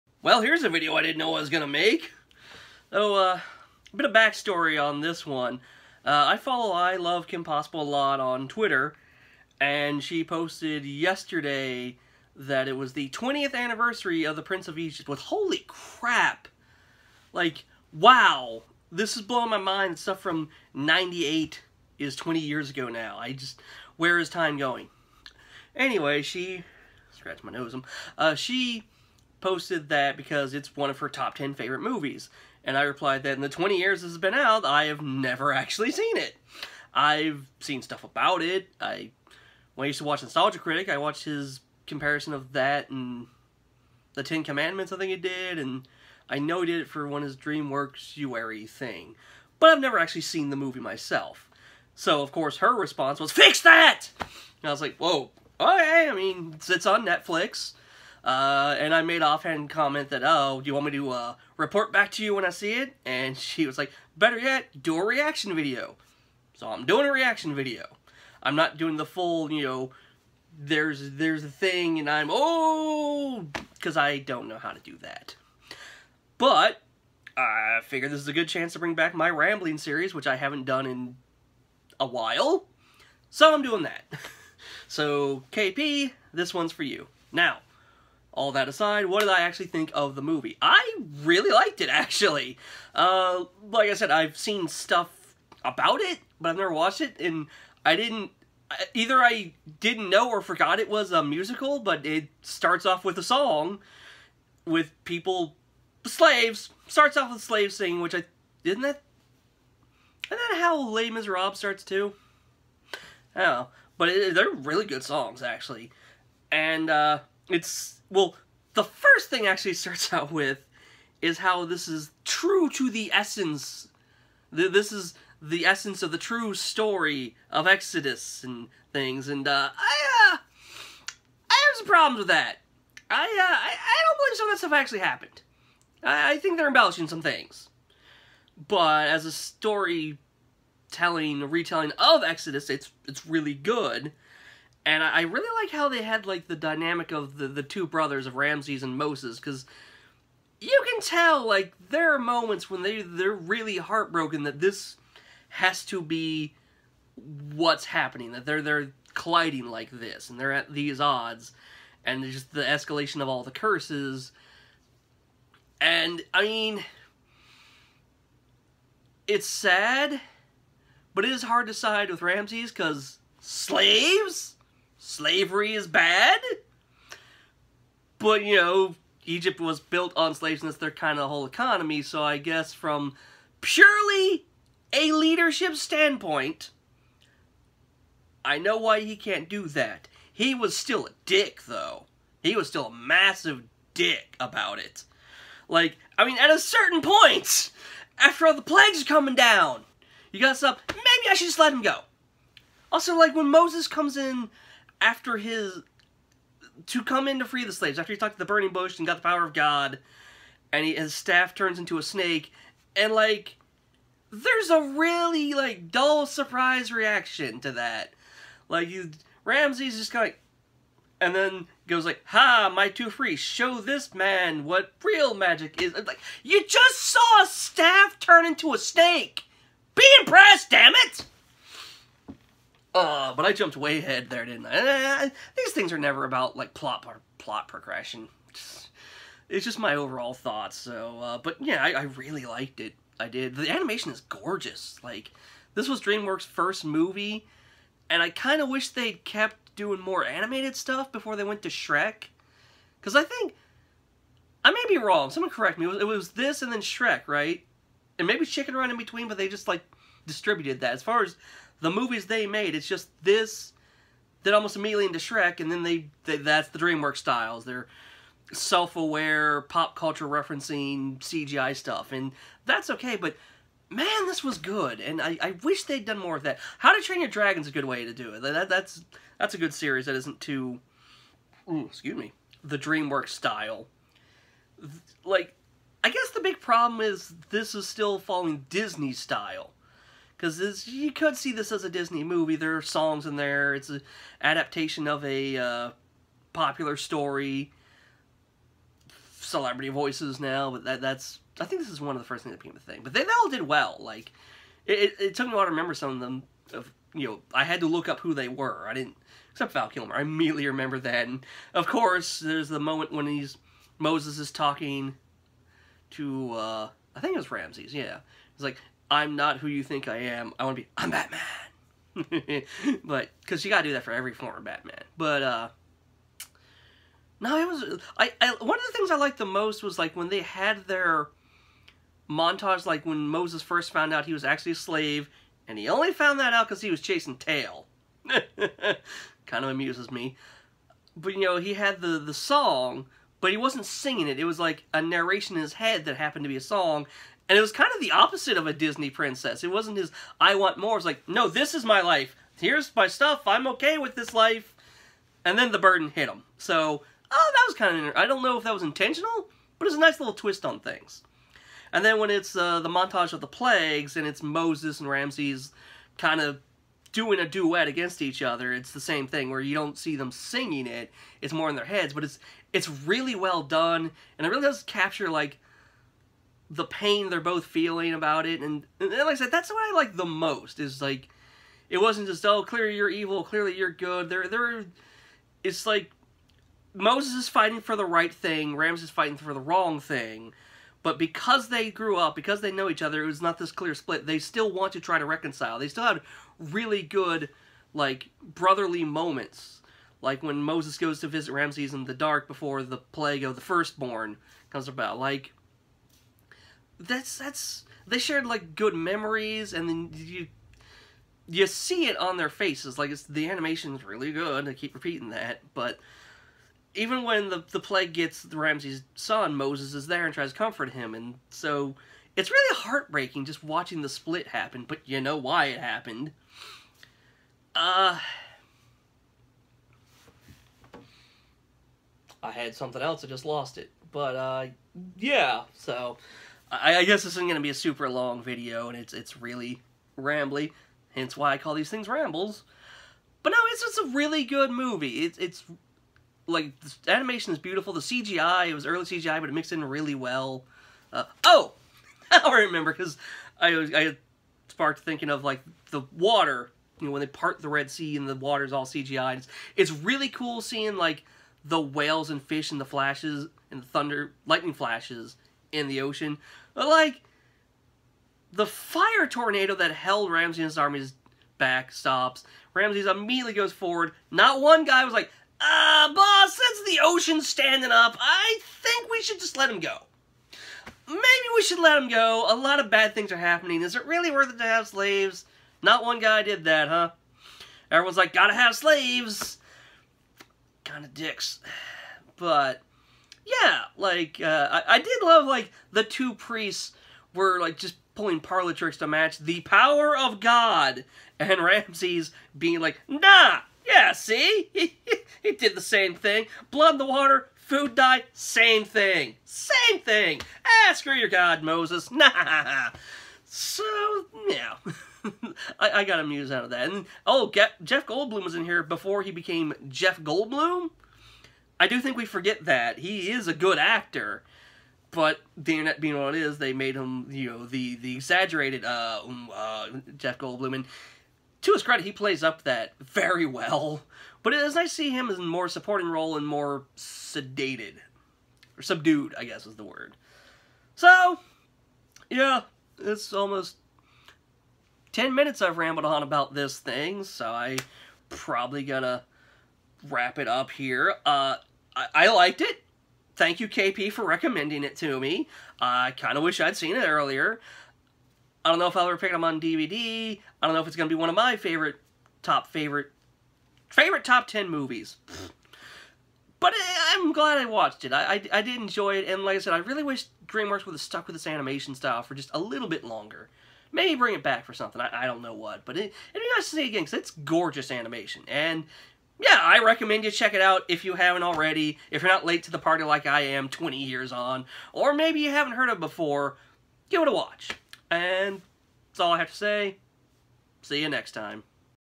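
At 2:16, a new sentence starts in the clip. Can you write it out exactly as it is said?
I, I think they're embellishing some things.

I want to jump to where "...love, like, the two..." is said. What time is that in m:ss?
8:15.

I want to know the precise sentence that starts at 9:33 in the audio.
Maybe bring it back for something, I, I don't know what.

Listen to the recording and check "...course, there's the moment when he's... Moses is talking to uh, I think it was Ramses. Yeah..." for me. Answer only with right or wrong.
right.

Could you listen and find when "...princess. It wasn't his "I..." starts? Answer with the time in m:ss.
5:49.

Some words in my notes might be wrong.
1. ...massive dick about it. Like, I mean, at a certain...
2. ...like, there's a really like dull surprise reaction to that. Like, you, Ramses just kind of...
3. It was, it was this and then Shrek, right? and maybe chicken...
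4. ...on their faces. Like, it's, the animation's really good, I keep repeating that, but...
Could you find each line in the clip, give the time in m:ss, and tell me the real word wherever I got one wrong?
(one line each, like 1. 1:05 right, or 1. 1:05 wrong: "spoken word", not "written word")
1. 3:12 right
2. 3:33 right
3. 4:15 right
4. 6:52 right.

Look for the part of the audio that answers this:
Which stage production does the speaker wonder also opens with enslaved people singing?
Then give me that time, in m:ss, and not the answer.
1:50.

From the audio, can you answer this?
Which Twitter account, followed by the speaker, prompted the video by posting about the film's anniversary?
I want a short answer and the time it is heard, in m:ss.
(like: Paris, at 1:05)
I Love Kim Possible, at 0:06.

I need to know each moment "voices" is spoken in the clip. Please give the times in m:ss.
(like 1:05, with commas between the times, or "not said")
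4:59.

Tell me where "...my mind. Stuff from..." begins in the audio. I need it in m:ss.
0:19.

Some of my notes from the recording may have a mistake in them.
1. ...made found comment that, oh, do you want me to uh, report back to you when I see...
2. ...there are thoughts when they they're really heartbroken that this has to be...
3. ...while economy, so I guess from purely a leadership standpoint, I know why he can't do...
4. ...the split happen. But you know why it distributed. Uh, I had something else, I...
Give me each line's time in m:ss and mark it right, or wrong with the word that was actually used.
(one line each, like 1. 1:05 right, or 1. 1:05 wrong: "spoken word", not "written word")
1. 0:59 wrong: "offhand", not "found"
2. 2:31 wrong: "moments", not "thoughts"
3. 3:01 wrong: "whole", not "while"
4. 7:04 wrong: "happened", not "distributed".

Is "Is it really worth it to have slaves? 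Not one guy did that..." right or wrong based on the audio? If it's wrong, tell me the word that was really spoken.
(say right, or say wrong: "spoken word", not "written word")
right.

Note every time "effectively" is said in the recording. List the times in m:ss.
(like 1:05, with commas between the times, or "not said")
not said.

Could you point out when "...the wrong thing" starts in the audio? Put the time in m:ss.
6:29.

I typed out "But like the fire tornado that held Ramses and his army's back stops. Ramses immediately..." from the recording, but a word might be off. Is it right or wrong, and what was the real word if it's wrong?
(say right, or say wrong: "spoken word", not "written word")
right.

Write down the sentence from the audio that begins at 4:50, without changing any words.
Because you could see this as a Disney movie.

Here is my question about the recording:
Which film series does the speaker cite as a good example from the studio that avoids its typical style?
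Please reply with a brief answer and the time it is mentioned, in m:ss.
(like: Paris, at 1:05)
How to Train Your Dragon, at 4:36.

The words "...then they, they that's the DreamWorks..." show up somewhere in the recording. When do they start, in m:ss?
4:25.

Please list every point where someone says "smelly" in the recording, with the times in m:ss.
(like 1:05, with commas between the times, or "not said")
not said.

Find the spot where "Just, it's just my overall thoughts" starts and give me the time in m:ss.
3:58.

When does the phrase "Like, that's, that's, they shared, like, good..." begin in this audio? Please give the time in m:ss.
6:45.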